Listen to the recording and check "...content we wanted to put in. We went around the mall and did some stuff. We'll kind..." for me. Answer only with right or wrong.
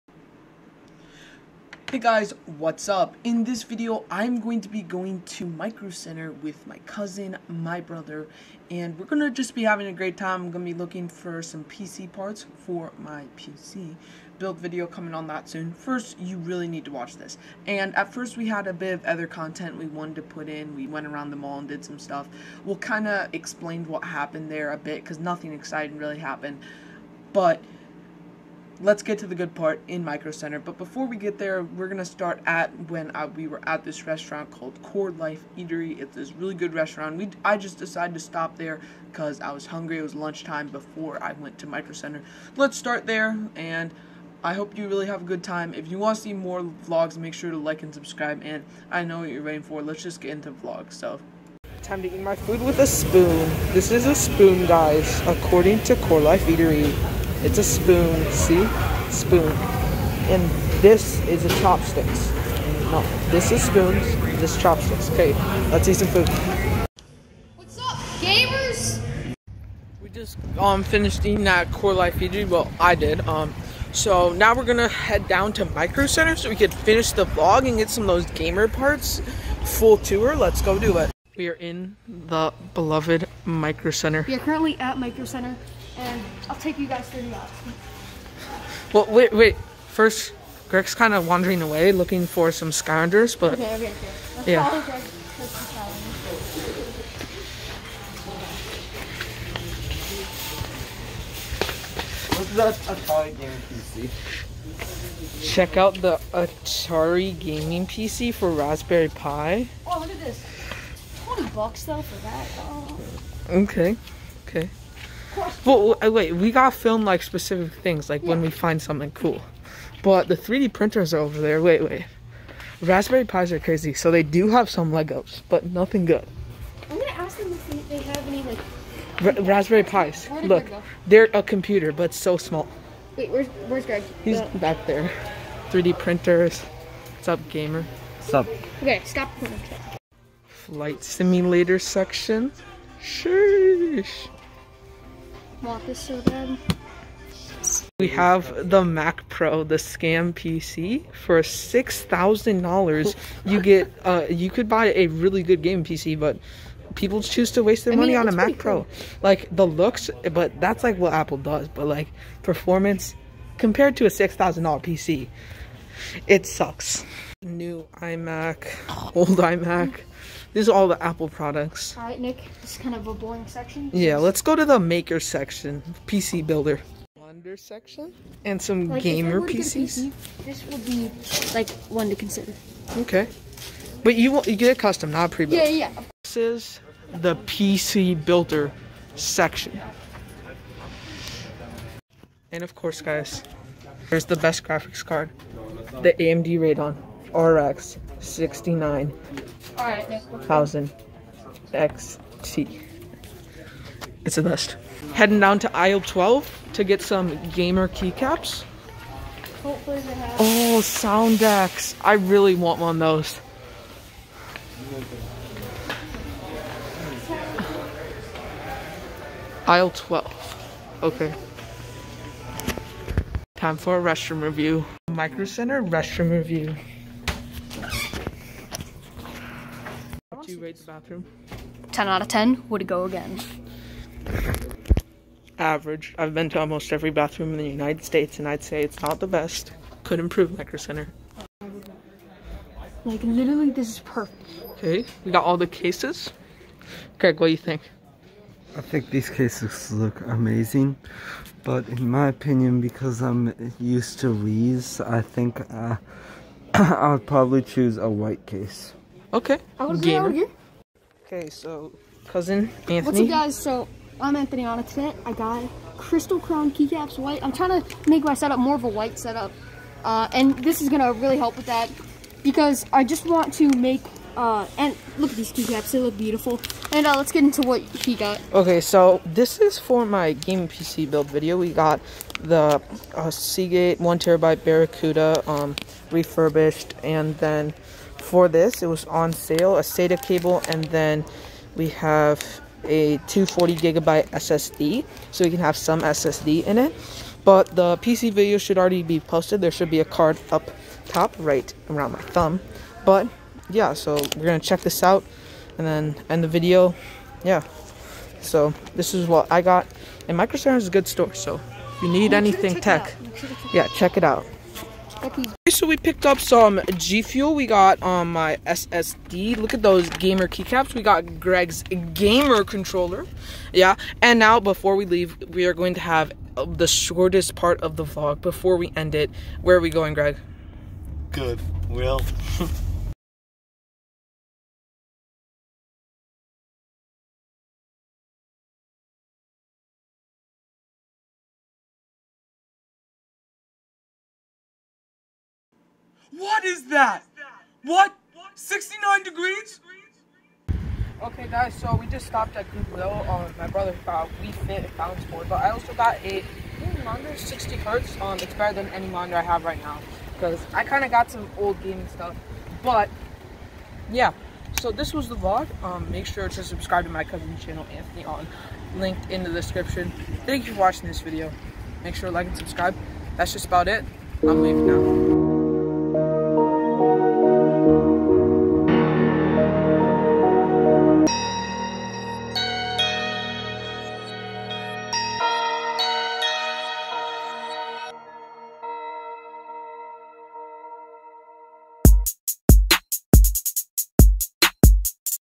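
right.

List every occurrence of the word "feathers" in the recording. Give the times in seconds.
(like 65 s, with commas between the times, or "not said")
not said.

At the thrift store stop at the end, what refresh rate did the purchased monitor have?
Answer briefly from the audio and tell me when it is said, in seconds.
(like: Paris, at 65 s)
60 Hz, at 357 s.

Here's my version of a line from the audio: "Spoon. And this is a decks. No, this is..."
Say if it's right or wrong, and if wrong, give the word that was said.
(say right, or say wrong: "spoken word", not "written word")
wrong: "chopsticks", not "decks".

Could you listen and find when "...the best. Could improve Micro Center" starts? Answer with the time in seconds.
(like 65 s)
239 s.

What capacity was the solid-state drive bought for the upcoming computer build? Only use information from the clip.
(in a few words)
240 GB.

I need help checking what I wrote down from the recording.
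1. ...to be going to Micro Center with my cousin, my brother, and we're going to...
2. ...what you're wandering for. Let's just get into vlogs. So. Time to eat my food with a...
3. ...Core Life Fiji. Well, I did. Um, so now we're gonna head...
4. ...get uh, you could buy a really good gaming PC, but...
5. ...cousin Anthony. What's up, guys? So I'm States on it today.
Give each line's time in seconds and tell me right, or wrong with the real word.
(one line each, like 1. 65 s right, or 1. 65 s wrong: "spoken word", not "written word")
1. 4 s right
2. 49 s wrong: "waiting", not "wandering"
3. 71 s right
4. 153 s right
5. 262 s wrong: "Anthony", not "States".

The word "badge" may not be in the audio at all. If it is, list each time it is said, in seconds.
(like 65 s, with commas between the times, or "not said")
not said.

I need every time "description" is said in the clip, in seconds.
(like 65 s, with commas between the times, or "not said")
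369 s.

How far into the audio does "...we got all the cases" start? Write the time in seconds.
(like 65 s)
245 s.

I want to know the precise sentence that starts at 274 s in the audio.
Uh, and look at these keycaps; they look beautiful.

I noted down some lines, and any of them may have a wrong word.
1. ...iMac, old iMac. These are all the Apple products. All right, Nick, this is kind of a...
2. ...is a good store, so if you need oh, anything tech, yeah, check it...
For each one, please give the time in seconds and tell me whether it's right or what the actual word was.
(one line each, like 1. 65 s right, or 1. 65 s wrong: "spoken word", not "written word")
1. 167 s right
2. 310 s right.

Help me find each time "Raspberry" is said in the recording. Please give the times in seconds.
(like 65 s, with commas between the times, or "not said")
108 s, 122 s, 129 s.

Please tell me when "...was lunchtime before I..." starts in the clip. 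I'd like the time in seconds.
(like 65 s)
40 s.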